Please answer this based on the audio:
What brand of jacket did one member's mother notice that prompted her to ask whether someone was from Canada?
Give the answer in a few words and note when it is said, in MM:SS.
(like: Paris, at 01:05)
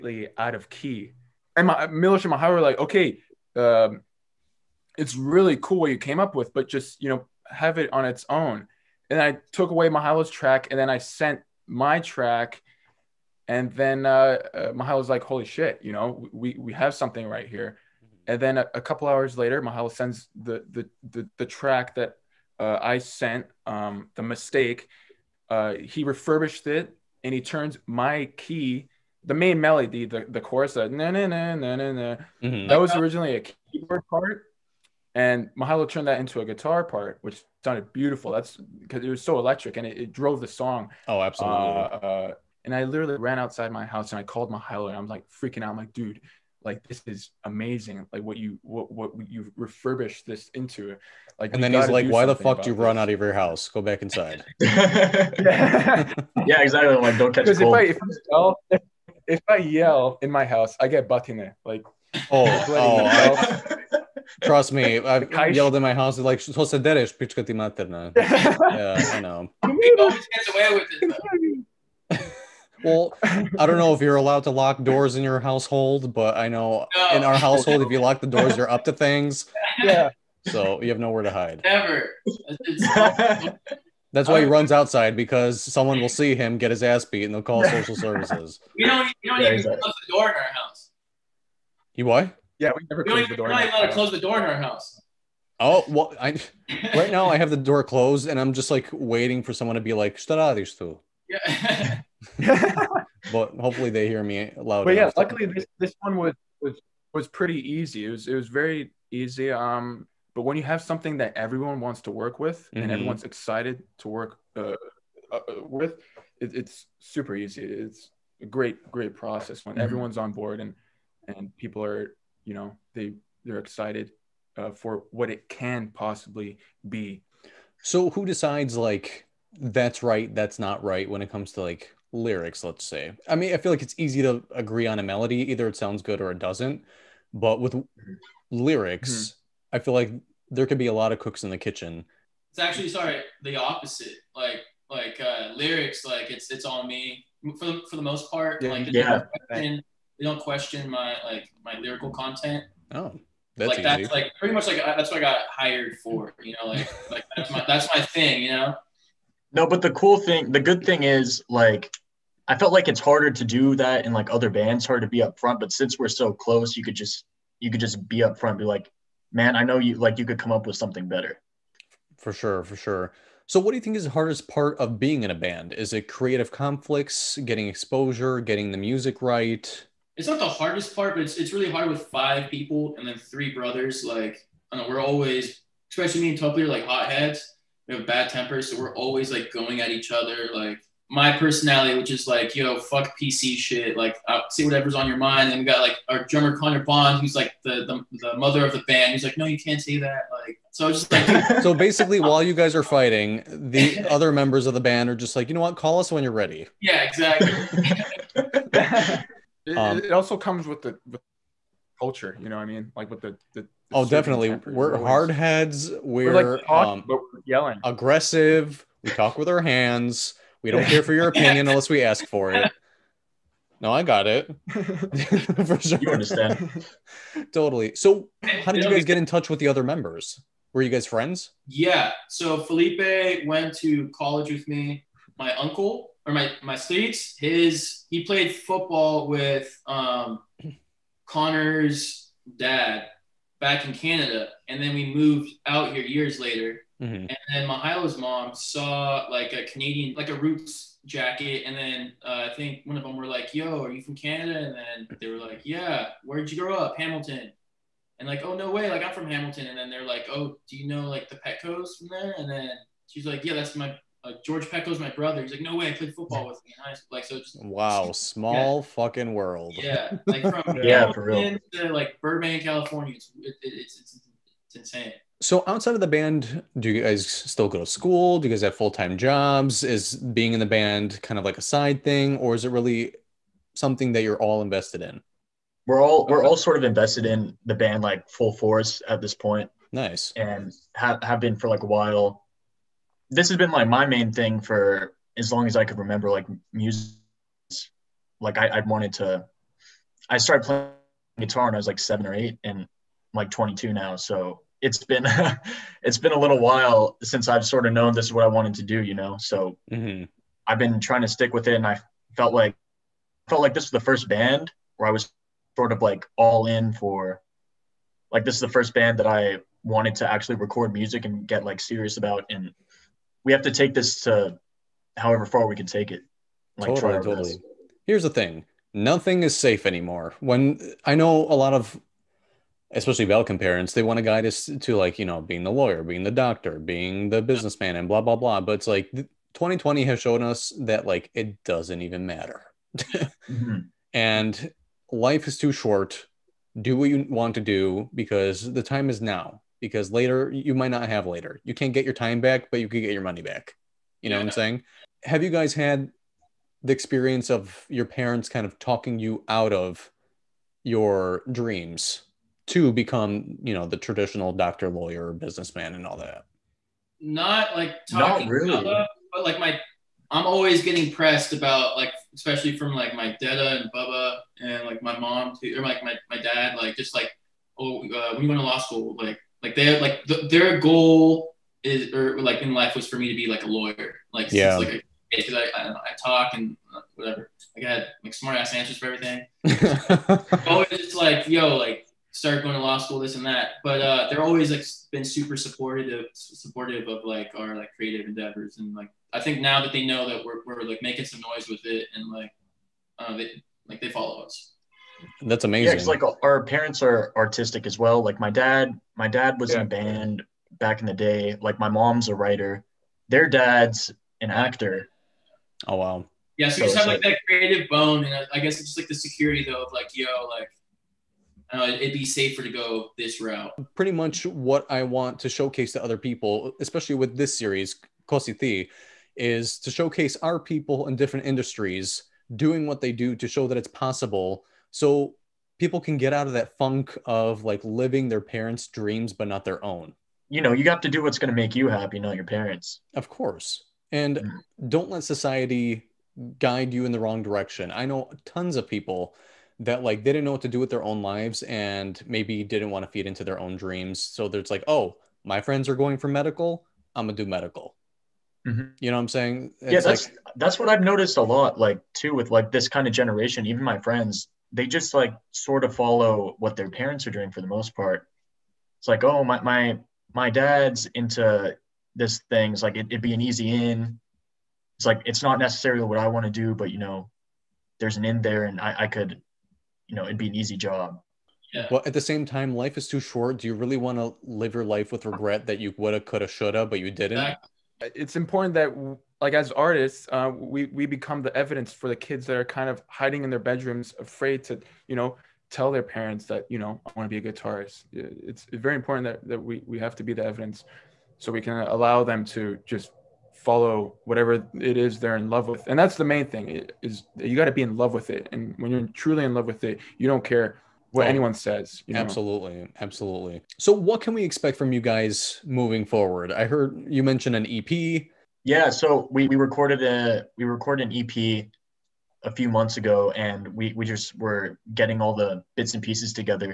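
Roots, at 04:10.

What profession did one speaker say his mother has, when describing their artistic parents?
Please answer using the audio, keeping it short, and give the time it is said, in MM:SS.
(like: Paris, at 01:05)
Writer, at 06:51.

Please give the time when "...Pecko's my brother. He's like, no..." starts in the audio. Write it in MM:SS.
04:24.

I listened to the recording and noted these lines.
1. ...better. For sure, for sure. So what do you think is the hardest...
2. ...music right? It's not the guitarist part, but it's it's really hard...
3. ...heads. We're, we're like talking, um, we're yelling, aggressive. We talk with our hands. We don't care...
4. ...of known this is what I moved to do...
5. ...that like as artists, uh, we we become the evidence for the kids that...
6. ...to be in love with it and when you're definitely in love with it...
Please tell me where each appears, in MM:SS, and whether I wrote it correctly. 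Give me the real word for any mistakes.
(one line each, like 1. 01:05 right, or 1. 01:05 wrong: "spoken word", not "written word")
1. 02:51 right
2. 02:58 wrong: "hardest", not "guitarist"
3. 03:35 right
4. 05:07 wrong: "wanted", not "moved"
5. 08:08 right
6. 08:27 wrong: "truly", not "definitely".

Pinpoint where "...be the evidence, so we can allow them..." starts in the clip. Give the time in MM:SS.
08:20.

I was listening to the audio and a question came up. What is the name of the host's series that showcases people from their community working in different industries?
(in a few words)
Ko Si Ti.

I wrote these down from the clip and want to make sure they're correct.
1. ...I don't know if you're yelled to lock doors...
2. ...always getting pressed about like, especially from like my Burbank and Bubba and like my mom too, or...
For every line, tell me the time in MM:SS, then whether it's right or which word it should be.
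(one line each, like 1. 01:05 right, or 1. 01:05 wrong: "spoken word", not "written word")
1. 01:13 wrong: "allowed", not "yelled"
2. 06:10 wrong: "Dada", not "Burbank".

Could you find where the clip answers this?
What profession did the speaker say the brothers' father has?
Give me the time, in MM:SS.
06:53.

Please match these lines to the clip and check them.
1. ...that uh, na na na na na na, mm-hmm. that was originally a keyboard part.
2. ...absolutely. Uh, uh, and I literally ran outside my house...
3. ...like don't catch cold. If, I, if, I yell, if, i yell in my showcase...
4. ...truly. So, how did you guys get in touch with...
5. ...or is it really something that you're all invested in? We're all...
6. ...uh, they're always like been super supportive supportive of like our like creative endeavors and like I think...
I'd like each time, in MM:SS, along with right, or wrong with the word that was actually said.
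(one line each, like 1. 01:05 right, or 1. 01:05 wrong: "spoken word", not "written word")
1. 00:30 right
2. 00:41 right
3. 00:56 wrong: "house", not "showcase"
4. 03:47 wrong: "totally", not "truly"
5. 04:42 right
6. 06:34 right.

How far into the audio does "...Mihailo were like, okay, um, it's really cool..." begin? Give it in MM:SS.
00:02.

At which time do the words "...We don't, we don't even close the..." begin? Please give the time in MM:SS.
01:28.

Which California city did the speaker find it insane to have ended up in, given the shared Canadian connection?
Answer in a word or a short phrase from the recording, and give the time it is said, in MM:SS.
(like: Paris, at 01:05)
Burbank, at 04:32.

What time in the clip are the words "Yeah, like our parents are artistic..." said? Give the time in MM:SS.
06:45.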